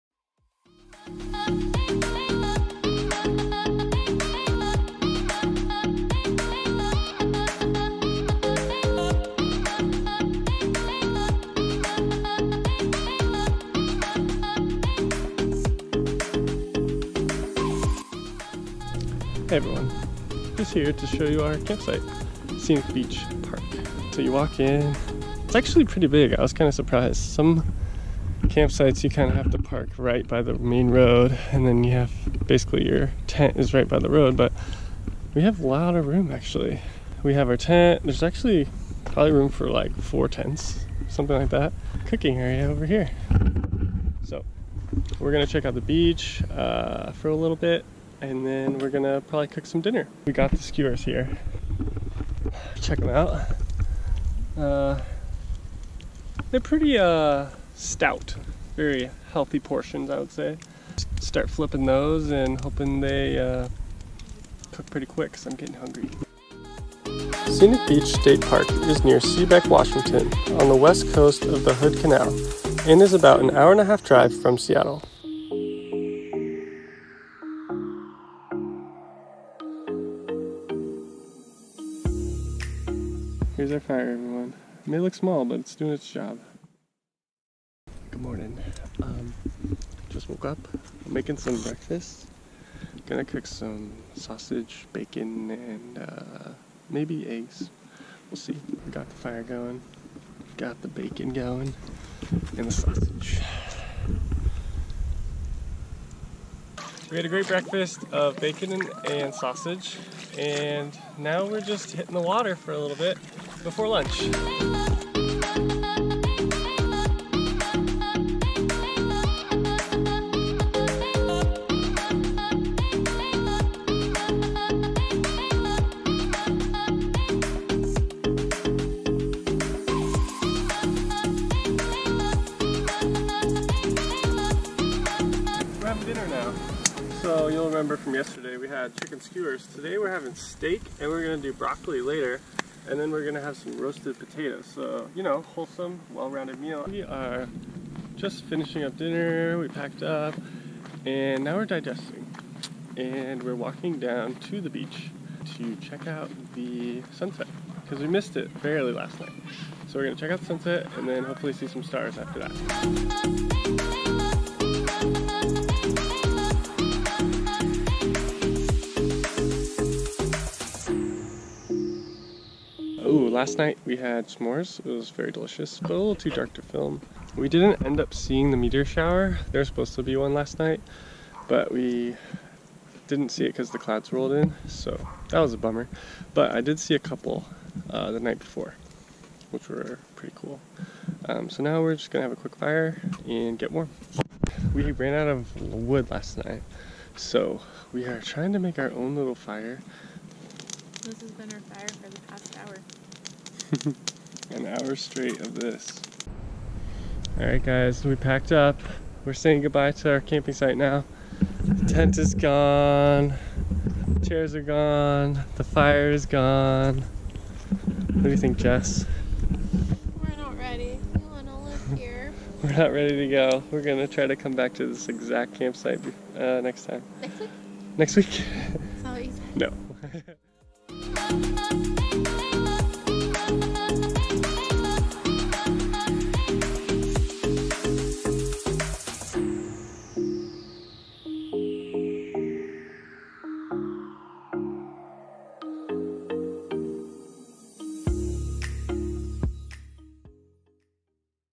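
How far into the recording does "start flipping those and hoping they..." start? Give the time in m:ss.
1:01.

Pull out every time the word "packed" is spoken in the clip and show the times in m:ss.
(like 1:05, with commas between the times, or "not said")
2:29, 3:28.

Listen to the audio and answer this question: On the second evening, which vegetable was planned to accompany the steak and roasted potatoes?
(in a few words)
broccoli.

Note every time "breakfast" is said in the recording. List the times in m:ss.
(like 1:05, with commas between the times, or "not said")
1:31, 1:47.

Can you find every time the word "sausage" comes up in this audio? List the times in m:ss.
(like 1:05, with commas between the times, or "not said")
1:34, 1:42, 1:49.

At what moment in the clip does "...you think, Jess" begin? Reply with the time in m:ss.
3:38.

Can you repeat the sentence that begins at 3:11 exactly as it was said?
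Um, so now we're just gonna have a quick fire and get warm.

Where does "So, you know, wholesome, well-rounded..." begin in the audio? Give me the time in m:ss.
2:24.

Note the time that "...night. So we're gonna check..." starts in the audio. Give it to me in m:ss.
2:39.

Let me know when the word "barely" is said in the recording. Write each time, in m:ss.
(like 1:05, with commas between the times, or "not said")
2:38.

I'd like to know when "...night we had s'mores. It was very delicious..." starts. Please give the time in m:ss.
2:53.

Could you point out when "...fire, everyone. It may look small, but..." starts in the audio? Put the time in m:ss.
1:23.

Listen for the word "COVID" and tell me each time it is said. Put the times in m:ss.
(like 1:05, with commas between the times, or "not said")
not said.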